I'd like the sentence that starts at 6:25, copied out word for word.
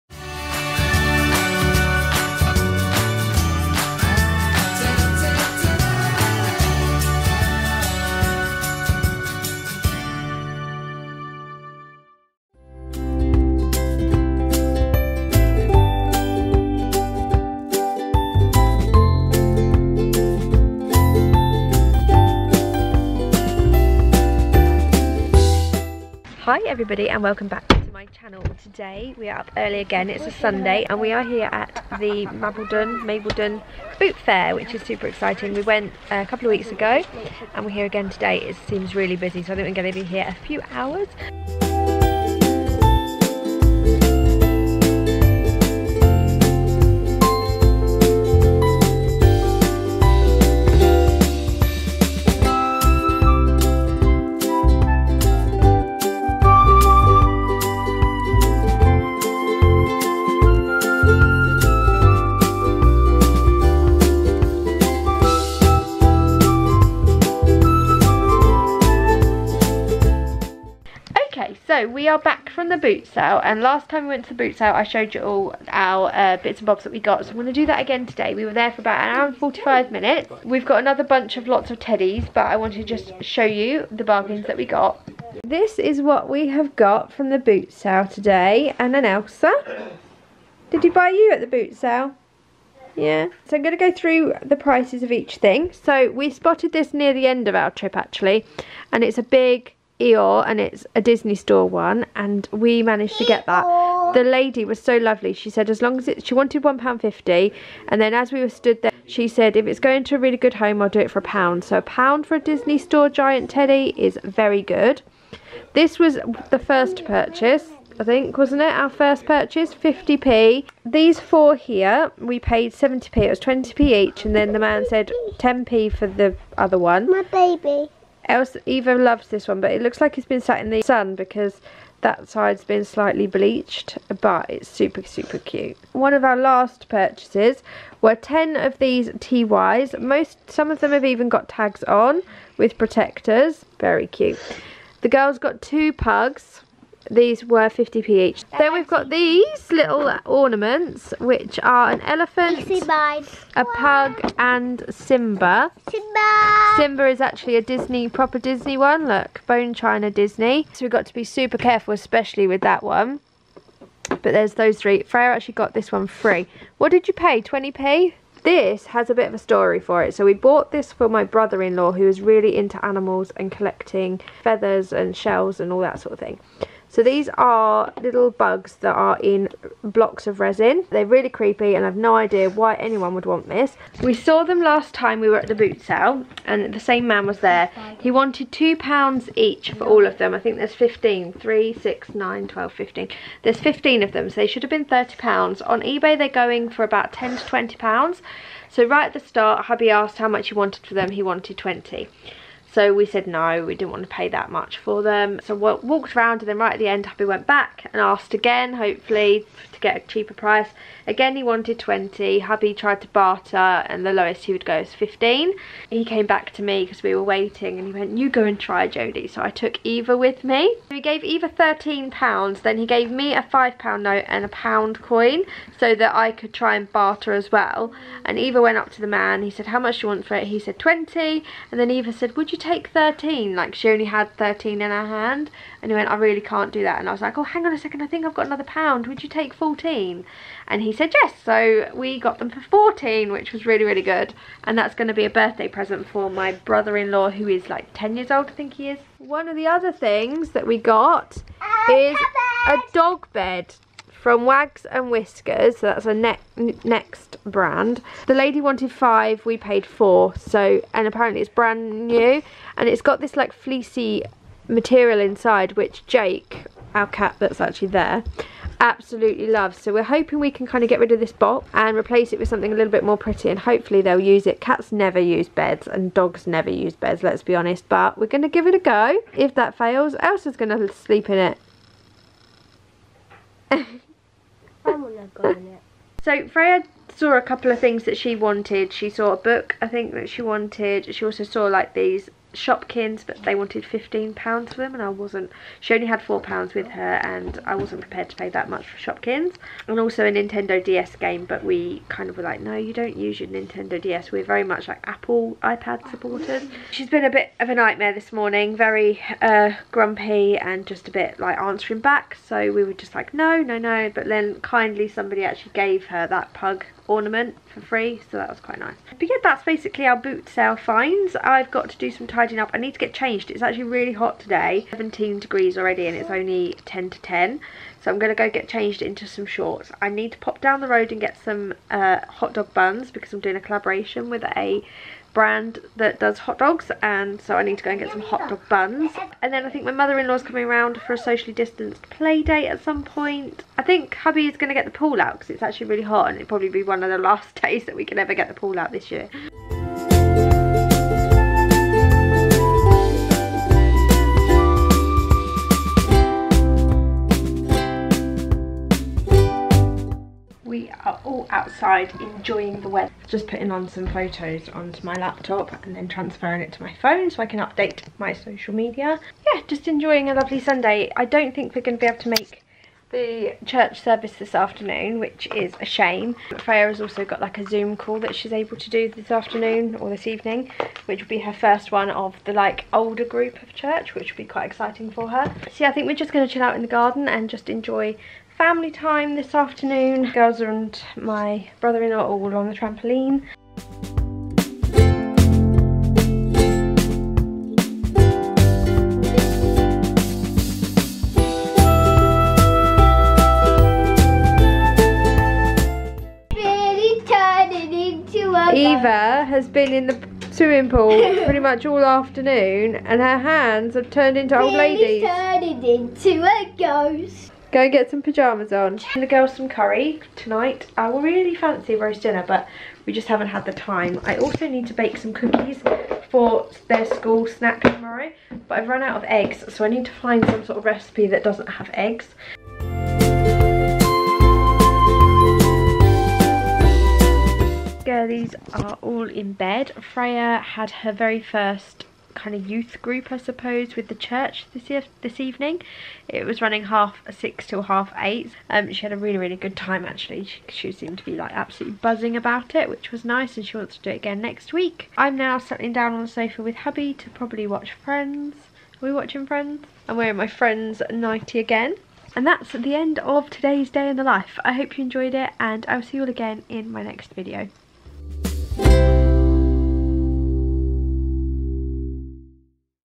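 So yeah, I think we're just going to chill out in the garden and just enjoy family time this afternoon.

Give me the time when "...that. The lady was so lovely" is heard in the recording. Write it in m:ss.
1:43.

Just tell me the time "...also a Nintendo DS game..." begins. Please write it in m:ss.
4:59.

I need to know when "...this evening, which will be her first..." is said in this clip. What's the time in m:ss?
6:20.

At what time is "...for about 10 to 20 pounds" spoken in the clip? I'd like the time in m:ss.
3:16.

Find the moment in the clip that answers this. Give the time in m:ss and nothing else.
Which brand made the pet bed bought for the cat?
4:14.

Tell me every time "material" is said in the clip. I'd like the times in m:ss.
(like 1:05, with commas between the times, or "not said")
4:24.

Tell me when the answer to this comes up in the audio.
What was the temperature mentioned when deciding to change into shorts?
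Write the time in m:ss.
5:24.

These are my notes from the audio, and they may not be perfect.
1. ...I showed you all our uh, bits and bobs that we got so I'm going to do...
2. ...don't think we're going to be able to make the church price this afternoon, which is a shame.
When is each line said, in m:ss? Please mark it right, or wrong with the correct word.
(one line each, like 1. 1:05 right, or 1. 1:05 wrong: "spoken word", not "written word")
1. 1:14 right
2. 6:11 wrong: "service", not "price".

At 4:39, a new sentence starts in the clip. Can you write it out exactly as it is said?
If that fails, Elsa's going to sleep in it So Freya saw a couple of things that she wanted.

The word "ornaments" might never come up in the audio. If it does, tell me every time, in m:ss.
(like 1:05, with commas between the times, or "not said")
2:30, 5:17.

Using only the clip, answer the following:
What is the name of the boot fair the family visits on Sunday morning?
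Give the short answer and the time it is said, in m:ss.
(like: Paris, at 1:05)
Mabledon Boot Fair, at 0:33.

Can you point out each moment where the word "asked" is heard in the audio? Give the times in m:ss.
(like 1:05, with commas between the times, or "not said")
3:19, 3:27.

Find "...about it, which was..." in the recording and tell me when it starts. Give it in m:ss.
7:32.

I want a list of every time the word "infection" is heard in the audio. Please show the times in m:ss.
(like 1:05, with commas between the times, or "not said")
not said.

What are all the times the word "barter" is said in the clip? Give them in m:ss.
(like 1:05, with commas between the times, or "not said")
3:33, 3:46.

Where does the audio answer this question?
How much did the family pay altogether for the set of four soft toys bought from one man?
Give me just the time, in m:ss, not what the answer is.
2:02.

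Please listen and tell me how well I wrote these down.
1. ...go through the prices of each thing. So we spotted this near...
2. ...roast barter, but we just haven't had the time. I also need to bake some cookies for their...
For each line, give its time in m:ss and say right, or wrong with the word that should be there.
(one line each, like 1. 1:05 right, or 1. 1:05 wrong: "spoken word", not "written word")
1. 1:33 right
2. 7:01 wrong: "dinner", not "barter".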